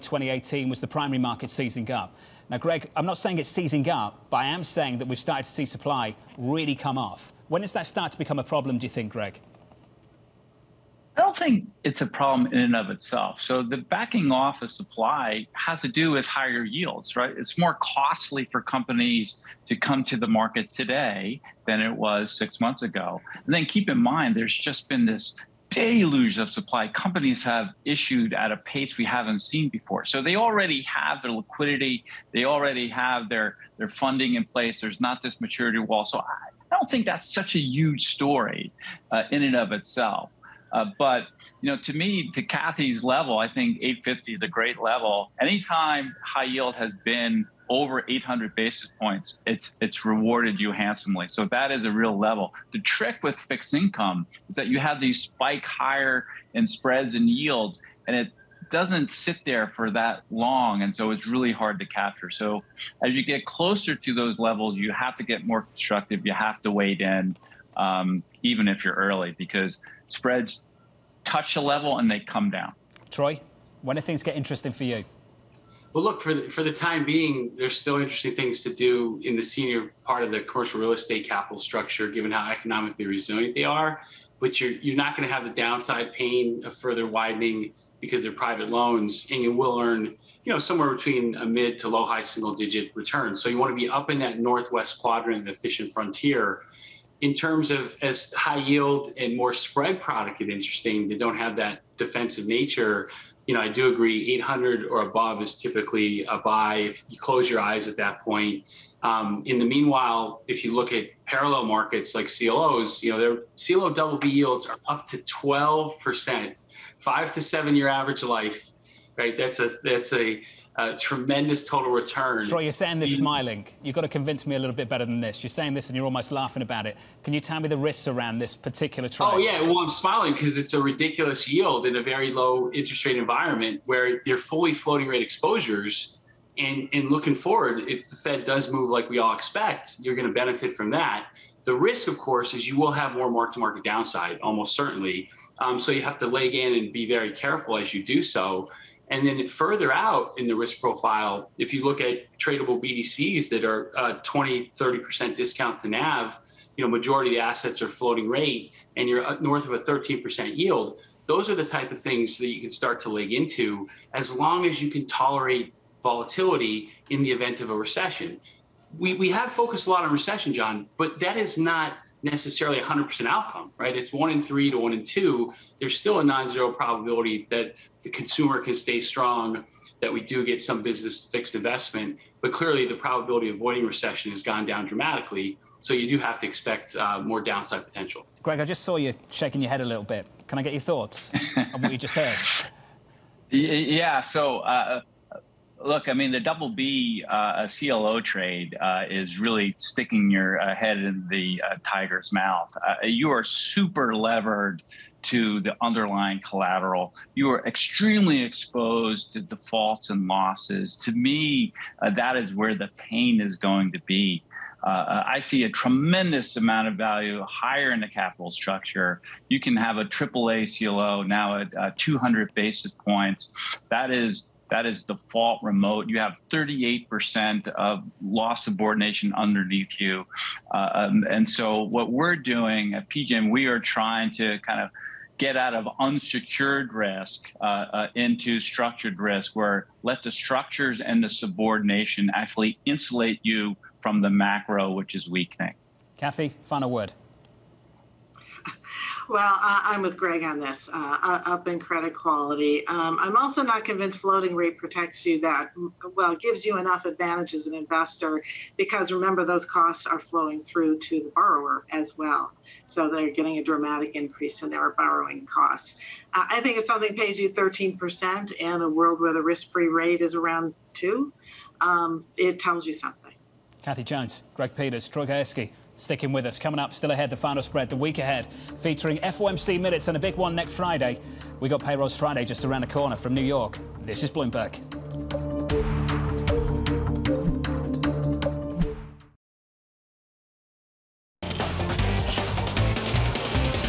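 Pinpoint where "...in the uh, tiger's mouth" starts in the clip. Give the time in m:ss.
3:20.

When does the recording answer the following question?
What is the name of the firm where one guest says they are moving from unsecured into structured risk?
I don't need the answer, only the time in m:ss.
3:53.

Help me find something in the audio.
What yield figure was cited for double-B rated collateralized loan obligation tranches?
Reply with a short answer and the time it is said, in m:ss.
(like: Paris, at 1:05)
12%, at 1:55.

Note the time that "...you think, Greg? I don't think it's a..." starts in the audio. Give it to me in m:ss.
0:08.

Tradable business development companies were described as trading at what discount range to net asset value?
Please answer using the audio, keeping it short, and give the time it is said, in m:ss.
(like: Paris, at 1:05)
20-30%, at 2:34.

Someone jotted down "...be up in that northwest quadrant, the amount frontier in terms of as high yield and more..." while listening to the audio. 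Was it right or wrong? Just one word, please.
wrong.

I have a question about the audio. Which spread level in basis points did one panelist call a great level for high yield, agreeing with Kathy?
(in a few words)
850.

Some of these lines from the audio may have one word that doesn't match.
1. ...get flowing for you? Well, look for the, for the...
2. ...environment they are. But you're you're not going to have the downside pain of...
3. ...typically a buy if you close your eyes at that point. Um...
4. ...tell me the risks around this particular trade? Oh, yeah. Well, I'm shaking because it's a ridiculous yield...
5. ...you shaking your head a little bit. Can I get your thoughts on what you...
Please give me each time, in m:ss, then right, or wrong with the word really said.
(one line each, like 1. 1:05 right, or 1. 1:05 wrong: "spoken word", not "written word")
1. 1:14 wrong: "interesting", not "flowing"
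2. 1:23 wrong: "resilient", not "environment"
3. 1:45 right
4. 2:07 wrong: "smiling", not "shaking"
5. 3:08 right.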